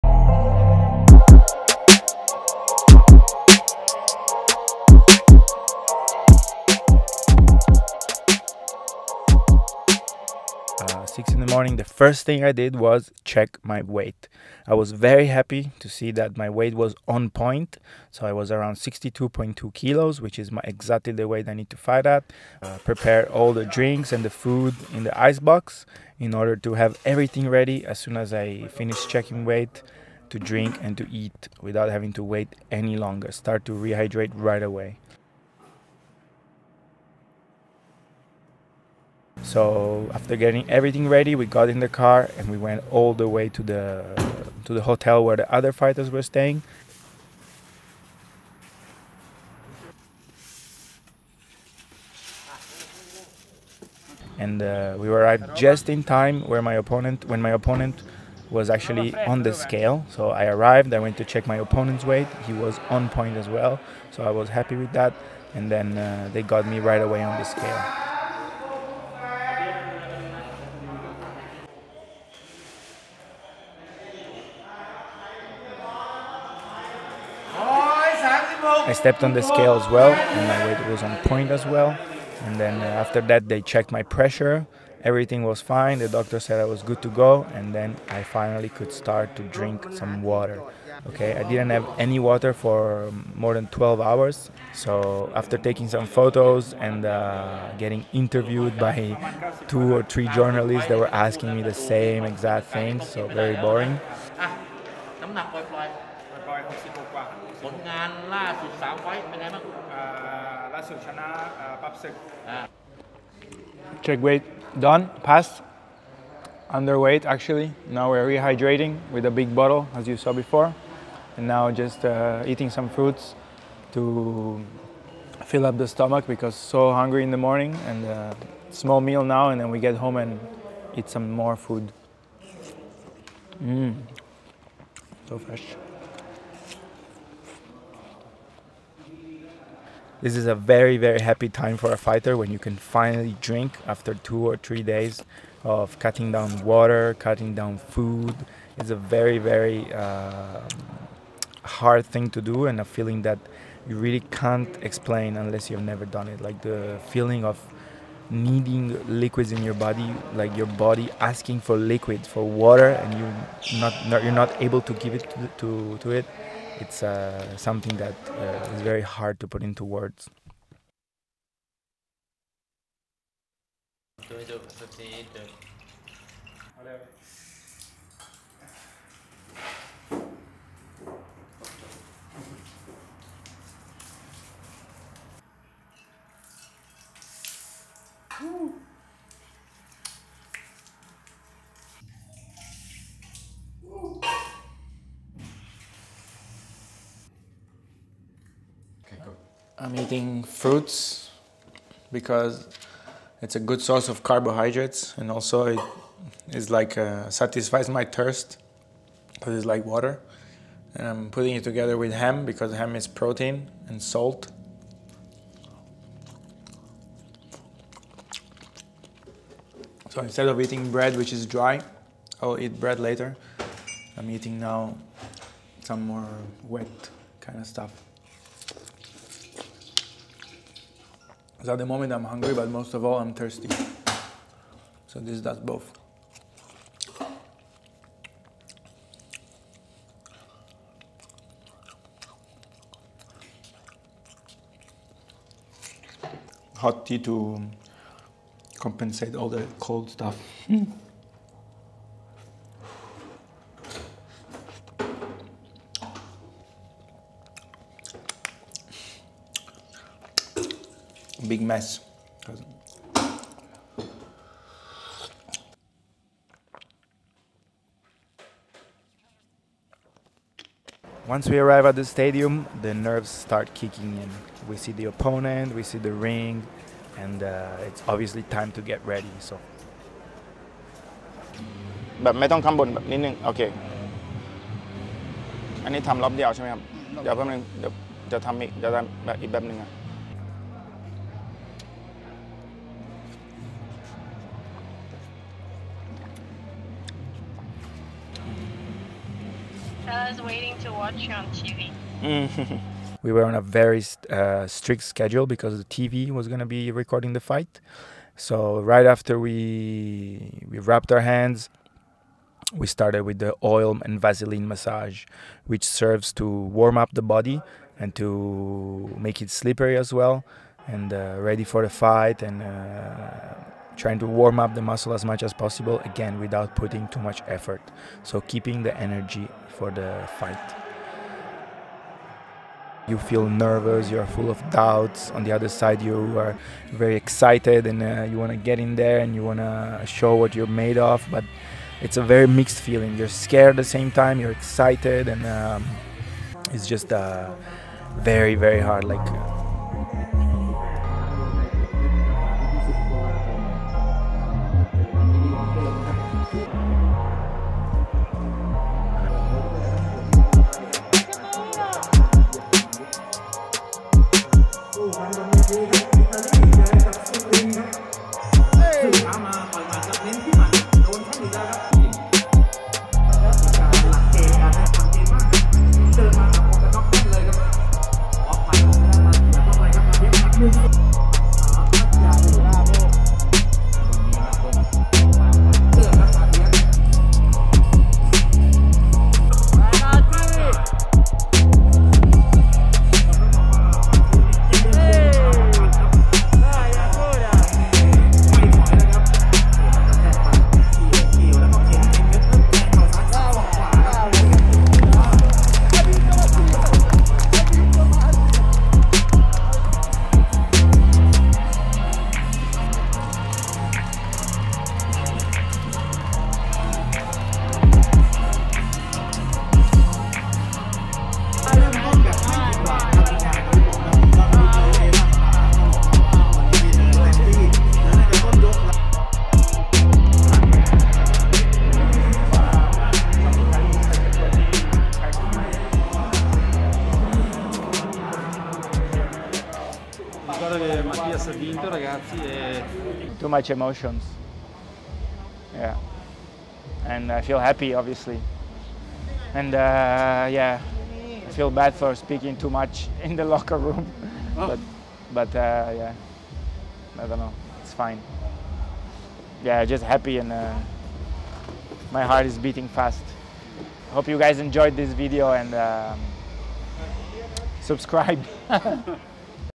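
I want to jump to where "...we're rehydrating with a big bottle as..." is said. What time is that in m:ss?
1:58.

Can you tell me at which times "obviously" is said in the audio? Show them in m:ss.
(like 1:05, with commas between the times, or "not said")
4:38, 7:27.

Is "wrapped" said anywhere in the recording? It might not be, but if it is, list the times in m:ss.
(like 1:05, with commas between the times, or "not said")
5:10.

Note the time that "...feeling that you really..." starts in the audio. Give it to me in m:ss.
2:32.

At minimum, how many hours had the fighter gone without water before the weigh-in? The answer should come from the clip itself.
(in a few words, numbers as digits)
12 hours.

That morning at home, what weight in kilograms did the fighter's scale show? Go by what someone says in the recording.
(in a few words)
62.2 kilos.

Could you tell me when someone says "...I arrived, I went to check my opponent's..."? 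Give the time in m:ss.
1:00.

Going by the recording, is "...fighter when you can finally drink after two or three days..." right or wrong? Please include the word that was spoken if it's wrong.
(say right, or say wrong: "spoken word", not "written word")
right.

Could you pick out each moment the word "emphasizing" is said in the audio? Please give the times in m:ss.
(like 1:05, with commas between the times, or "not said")
not said.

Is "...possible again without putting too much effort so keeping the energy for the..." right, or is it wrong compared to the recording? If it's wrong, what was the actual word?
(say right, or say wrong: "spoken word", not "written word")
right.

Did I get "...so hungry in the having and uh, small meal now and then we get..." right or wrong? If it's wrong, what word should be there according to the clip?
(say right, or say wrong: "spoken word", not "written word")
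wrong: "morning", not "having".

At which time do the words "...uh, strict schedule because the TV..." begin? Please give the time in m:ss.
5:04.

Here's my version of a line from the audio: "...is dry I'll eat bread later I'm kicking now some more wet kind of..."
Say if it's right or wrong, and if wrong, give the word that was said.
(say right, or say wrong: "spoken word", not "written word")
wrong: "eating", not "kicking".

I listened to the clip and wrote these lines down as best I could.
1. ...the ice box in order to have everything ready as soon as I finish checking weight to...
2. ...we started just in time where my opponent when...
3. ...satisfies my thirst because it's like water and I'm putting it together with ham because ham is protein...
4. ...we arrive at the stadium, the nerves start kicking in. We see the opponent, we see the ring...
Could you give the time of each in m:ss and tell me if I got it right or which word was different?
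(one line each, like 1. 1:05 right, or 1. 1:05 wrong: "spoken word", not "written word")
1. 0:25 right
2. 0:54 wrong: "arrived", not "started"
3. 3:27 right
4. 4:31 right.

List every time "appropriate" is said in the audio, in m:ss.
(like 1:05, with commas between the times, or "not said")
not said.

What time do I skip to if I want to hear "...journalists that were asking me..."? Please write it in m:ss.
1:40.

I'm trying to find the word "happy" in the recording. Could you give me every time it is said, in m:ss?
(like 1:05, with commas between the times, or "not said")
0:15, 1:04, 2:21, 7:27, 7:40.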